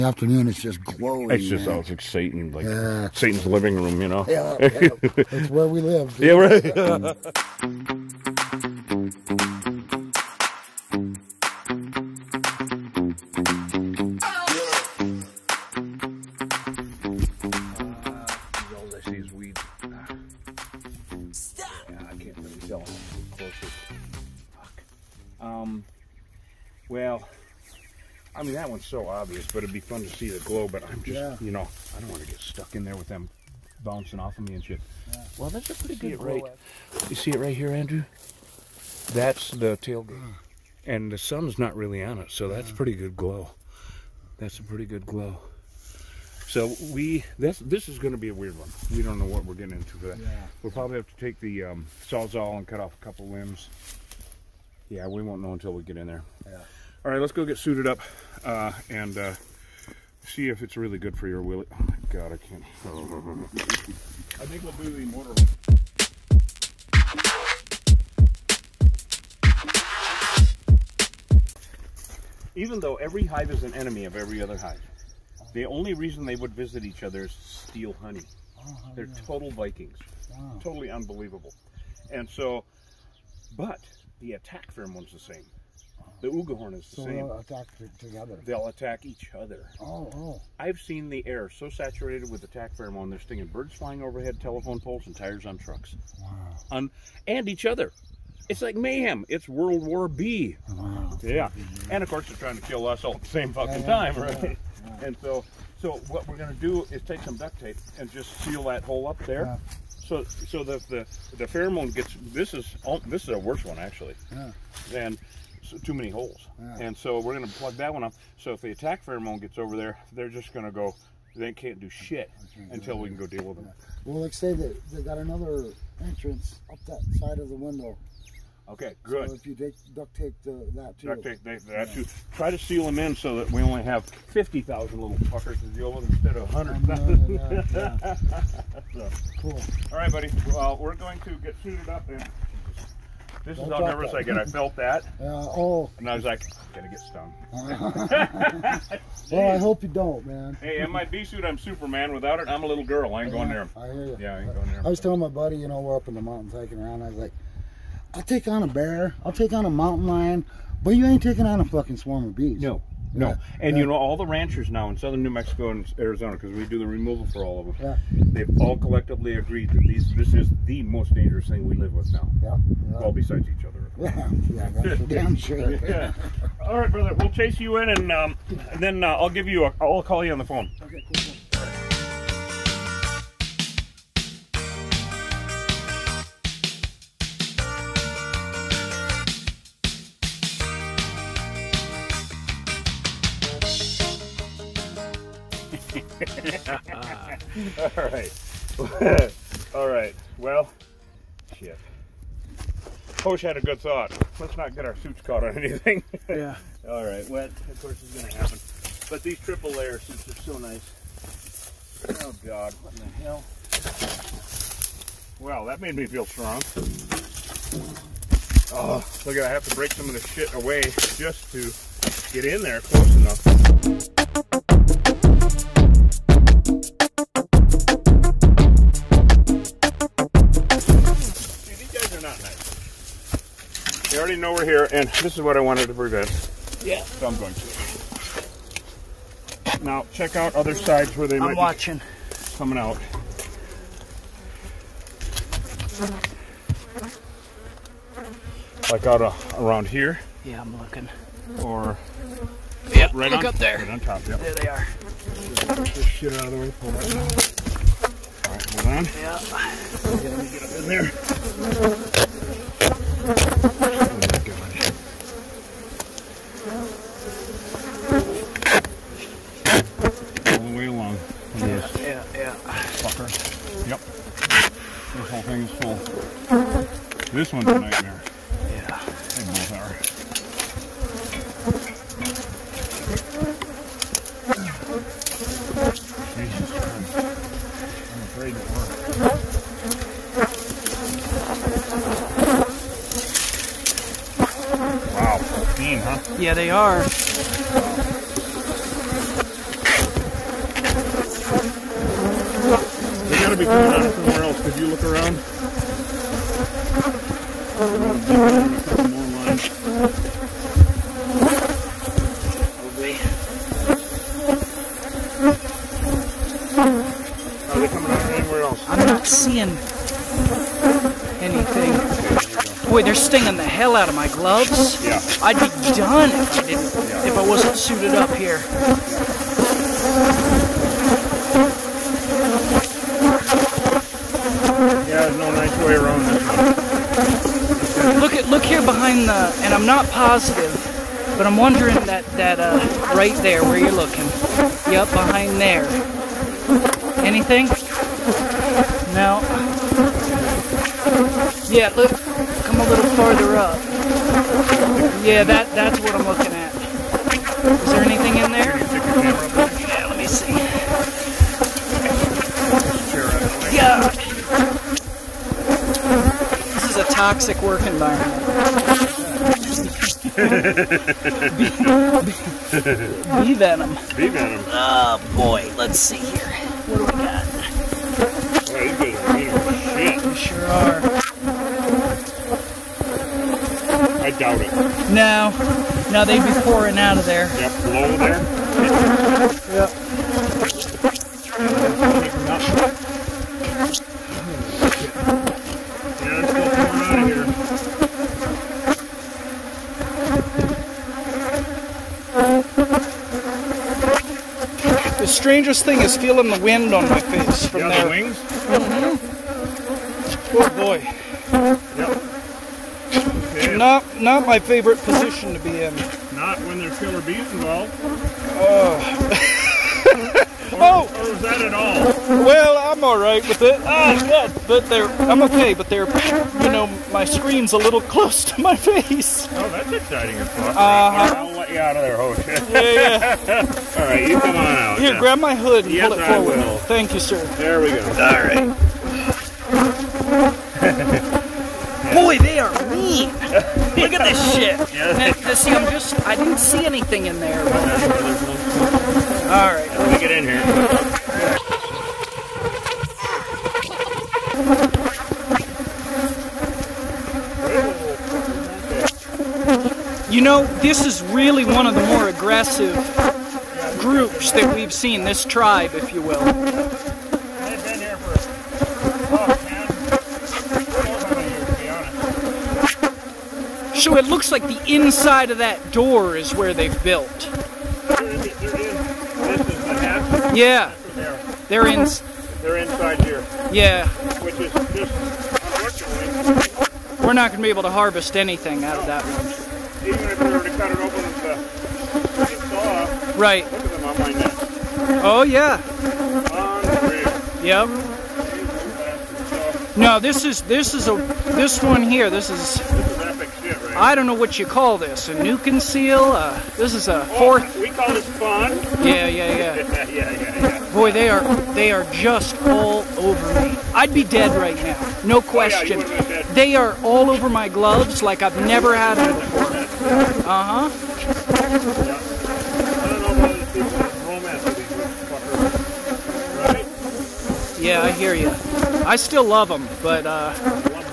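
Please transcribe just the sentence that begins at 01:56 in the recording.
And so we're going to plug that one up.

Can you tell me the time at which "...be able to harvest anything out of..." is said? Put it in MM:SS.
08:07.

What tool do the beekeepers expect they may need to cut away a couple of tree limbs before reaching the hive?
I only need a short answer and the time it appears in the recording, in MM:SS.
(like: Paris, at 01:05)
sawzall, at 00:52.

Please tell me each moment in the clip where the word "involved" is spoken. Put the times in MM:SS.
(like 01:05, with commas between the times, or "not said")
06:57.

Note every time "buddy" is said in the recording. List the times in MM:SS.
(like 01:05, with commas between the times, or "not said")
02:20, 02:35.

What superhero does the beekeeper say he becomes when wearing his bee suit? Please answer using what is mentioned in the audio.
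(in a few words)
Superman.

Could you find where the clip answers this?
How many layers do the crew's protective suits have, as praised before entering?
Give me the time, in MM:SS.
03:29.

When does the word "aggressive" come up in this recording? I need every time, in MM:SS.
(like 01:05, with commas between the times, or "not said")
07:42.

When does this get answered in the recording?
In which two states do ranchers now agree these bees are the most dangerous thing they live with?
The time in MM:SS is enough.
02:45.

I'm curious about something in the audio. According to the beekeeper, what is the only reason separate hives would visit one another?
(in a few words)
steal honey.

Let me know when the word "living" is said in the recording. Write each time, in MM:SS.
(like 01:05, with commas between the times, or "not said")
00:03.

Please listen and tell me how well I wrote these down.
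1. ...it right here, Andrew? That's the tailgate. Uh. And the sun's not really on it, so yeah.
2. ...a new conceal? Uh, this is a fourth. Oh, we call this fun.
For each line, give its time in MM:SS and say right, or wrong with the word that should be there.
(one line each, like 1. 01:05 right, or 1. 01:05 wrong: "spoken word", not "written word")
1. 00:37 right
2. 08:25 right.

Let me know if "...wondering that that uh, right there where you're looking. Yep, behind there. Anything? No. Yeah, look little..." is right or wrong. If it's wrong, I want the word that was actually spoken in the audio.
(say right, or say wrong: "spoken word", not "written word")
right.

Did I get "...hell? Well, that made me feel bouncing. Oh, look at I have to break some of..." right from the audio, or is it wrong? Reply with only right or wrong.
wrong.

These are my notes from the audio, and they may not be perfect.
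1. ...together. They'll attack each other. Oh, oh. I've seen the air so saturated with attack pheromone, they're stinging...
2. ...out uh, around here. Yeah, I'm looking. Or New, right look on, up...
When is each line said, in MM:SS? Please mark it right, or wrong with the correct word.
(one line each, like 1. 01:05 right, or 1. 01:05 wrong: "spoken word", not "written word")
1. 01:27 right
2. 04:09 wrong: "Yep", not "New".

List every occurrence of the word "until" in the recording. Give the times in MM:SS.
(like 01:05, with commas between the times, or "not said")
00:55, 02:02.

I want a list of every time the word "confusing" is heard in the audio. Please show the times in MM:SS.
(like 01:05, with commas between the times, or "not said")
not said.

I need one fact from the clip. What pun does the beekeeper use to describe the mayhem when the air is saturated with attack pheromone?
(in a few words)
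World War B.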